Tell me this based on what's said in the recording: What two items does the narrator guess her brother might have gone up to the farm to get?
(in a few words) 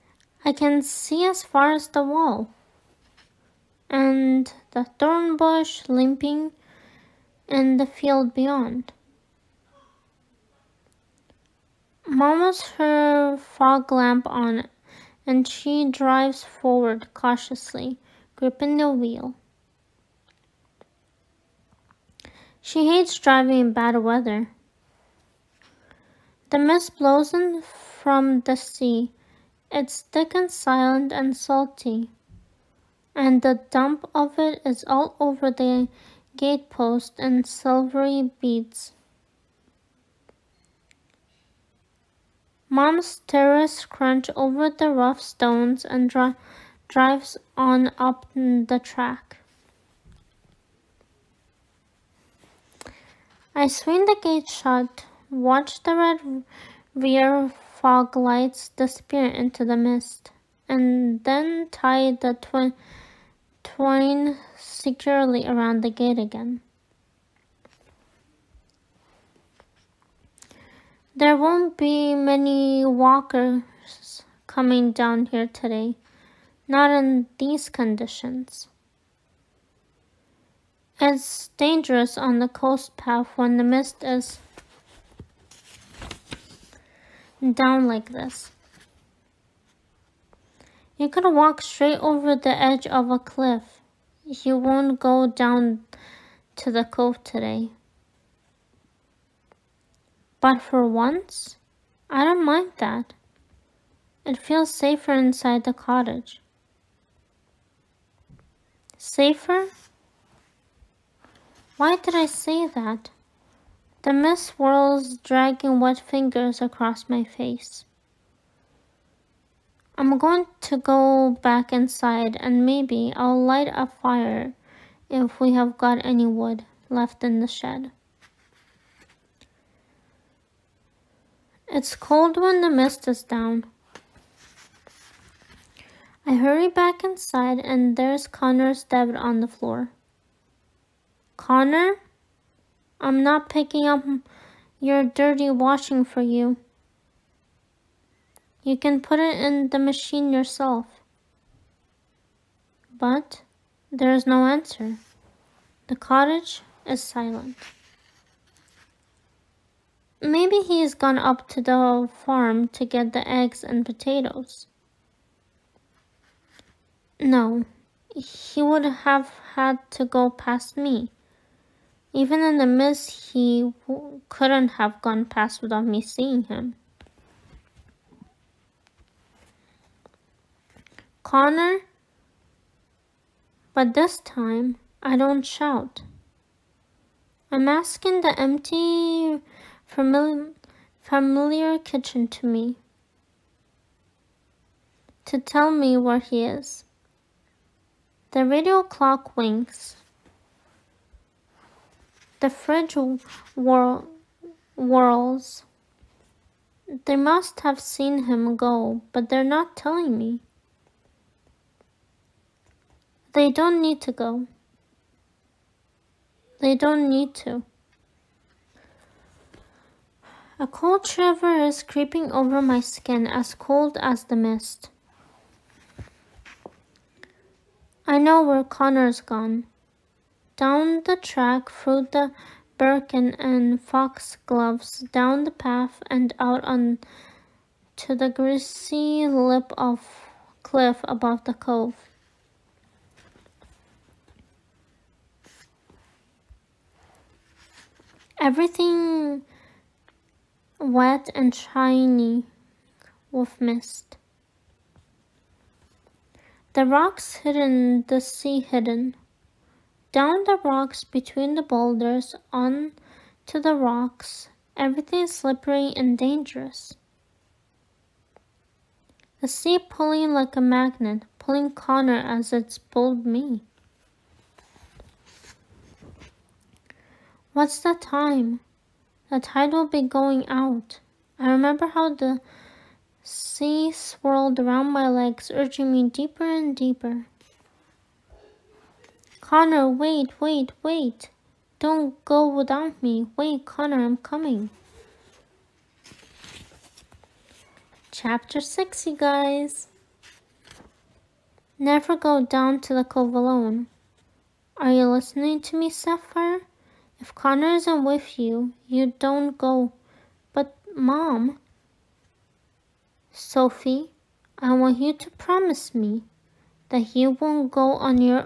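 eggs and potatoes.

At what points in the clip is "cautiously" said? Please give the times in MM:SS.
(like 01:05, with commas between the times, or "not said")
00:17.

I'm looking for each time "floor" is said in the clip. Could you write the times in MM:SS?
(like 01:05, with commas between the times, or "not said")
02:19.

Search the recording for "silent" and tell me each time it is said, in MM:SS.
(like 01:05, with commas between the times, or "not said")
00:30, 02:37.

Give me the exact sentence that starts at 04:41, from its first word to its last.
I remember how the sea swirled around my legs, urging me deeper and deeper.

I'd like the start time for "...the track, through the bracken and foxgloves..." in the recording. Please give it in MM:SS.
03:51.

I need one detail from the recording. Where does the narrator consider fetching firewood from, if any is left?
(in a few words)
the shed.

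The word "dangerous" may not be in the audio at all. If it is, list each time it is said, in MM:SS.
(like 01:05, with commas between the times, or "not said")
01:21, 04:26.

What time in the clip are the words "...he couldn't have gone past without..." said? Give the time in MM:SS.
02:53.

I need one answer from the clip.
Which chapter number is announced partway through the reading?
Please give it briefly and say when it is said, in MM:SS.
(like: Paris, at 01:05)
6, at 04:58.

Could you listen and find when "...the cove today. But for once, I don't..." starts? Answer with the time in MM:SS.
01:36.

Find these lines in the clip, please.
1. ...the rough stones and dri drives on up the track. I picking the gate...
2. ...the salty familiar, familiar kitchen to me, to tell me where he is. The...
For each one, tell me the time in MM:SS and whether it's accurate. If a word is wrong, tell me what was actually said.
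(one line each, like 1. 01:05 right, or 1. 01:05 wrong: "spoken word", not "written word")
1. 00:44 wrong: "swing", not "picking"
2. 03:08 wrong: "empty", not "salty".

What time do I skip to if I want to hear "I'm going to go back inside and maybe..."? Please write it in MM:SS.
01:59.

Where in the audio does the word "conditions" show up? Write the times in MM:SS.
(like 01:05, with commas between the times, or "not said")
01:17.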